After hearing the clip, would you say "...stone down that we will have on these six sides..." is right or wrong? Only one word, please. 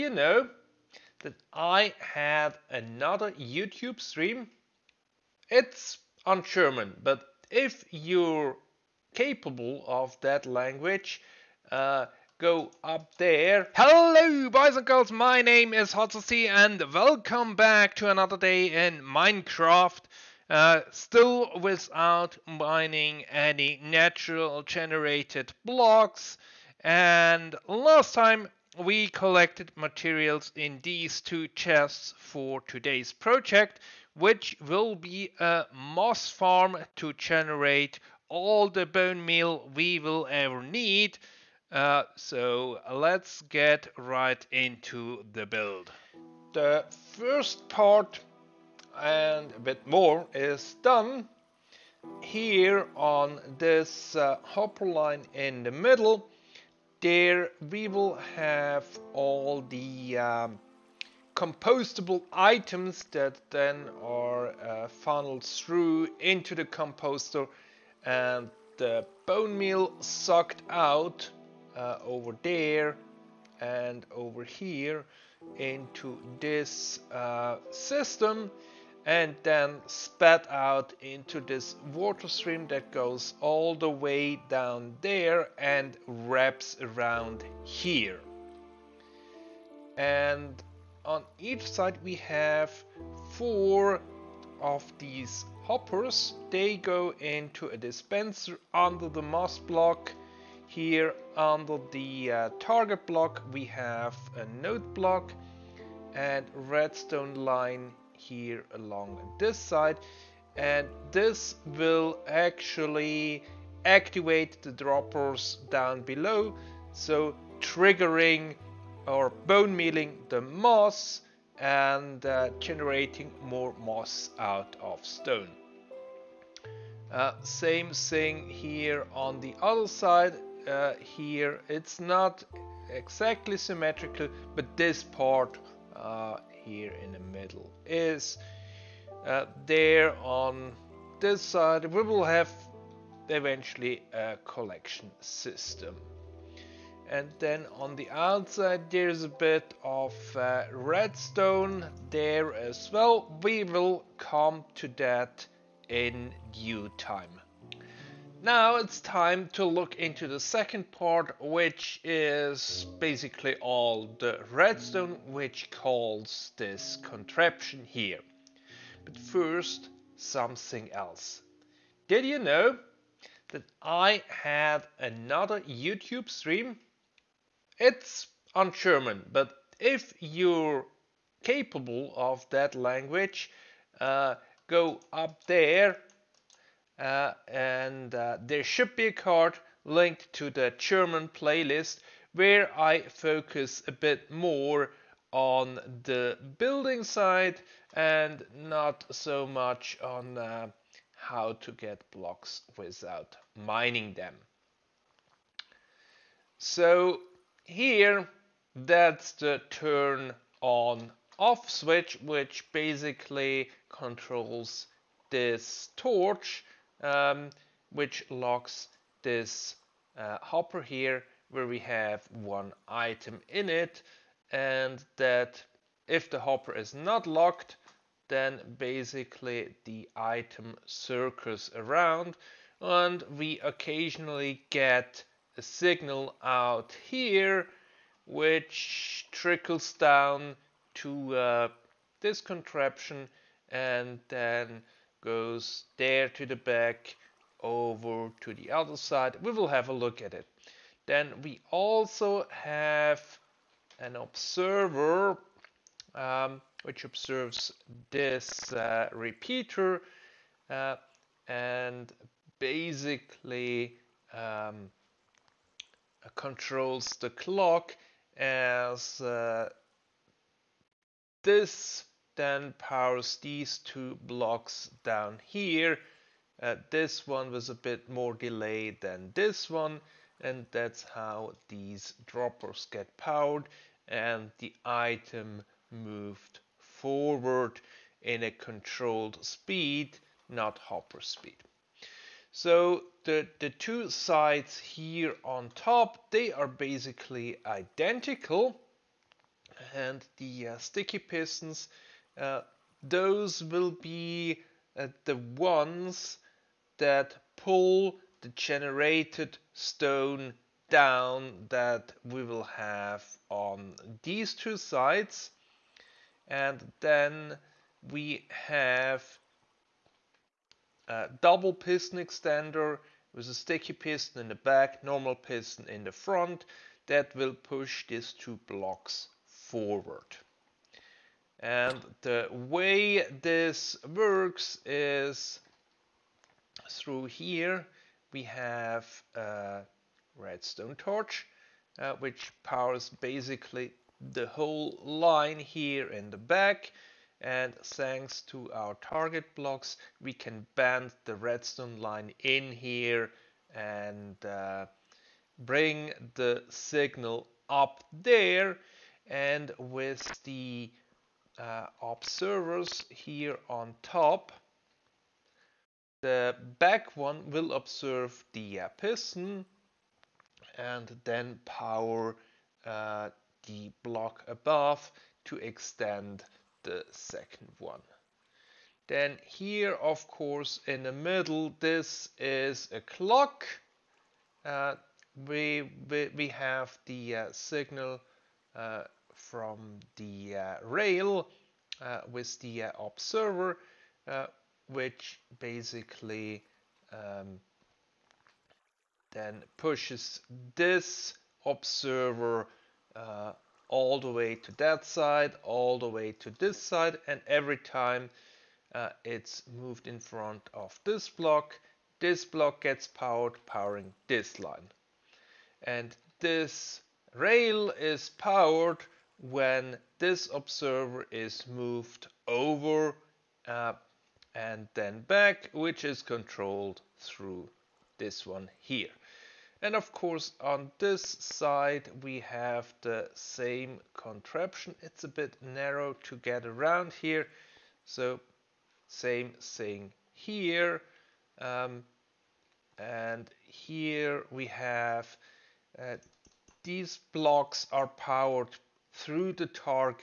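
wrong.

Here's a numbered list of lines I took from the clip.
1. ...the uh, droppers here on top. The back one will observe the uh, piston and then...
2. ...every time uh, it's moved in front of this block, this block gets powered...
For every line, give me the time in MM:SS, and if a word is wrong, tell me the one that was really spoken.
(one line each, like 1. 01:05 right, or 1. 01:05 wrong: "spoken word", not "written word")
1. 06:00 wrong: "observers", not "droppers"
2. 06:47 right.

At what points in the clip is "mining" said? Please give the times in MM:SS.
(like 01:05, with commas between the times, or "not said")
00:22, 03:23.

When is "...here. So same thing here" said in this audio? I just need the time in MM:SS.
07:17.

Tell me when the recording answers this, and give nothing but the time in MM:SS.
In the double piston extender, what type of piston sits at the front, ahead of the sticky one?
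05:25.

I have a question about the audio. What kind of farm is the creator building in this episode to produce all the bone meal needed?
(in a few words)
Moss farm.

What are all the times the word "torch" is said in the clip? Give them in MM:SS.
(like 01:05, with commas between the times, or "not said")
03:35, 05:40.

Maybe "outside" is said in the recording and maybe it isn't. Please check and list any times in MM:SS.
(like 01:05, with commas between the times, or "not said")
02:28.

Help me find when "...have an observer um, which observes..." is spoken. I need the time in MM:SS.
04:12.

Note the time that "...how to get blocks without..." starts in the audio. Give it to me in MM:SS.
03:21.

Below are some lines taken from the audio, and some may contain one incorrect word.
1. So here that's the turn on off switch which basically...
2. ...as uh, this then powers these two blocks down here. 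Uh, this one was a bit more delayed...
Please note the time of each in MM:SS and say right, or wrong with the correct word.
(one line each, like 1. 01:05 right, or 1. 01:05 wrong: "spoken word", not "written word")
1. 03:26 right
2. 04:28 right.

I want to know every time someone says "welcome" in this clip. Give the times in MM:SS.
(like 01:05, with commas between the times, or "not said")
00:16.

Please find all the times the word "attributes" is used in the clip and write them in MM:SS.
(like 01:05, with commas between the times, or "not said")
not said.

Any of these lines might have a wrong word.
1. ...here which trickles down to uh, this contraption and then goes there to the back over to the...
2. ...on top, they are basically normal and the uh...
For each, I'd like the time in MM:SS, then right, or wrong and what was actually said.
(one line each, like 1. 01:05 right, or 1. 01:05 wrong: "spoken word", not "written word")
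1. 03:57 right
2. 04:55 wrong: "identical", not "normal".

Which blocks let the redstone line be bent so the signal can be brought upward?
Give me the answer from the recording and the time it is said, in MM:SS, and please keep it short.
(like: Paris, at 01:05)
Target blocks, at 05:48.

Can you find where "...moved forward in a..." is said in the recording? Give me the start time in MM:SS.
04:45.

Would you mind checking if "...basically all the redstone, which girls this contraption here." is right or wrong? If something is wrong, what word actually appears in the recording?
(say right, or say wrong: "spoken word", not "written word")
wrong: "calls", not "girls".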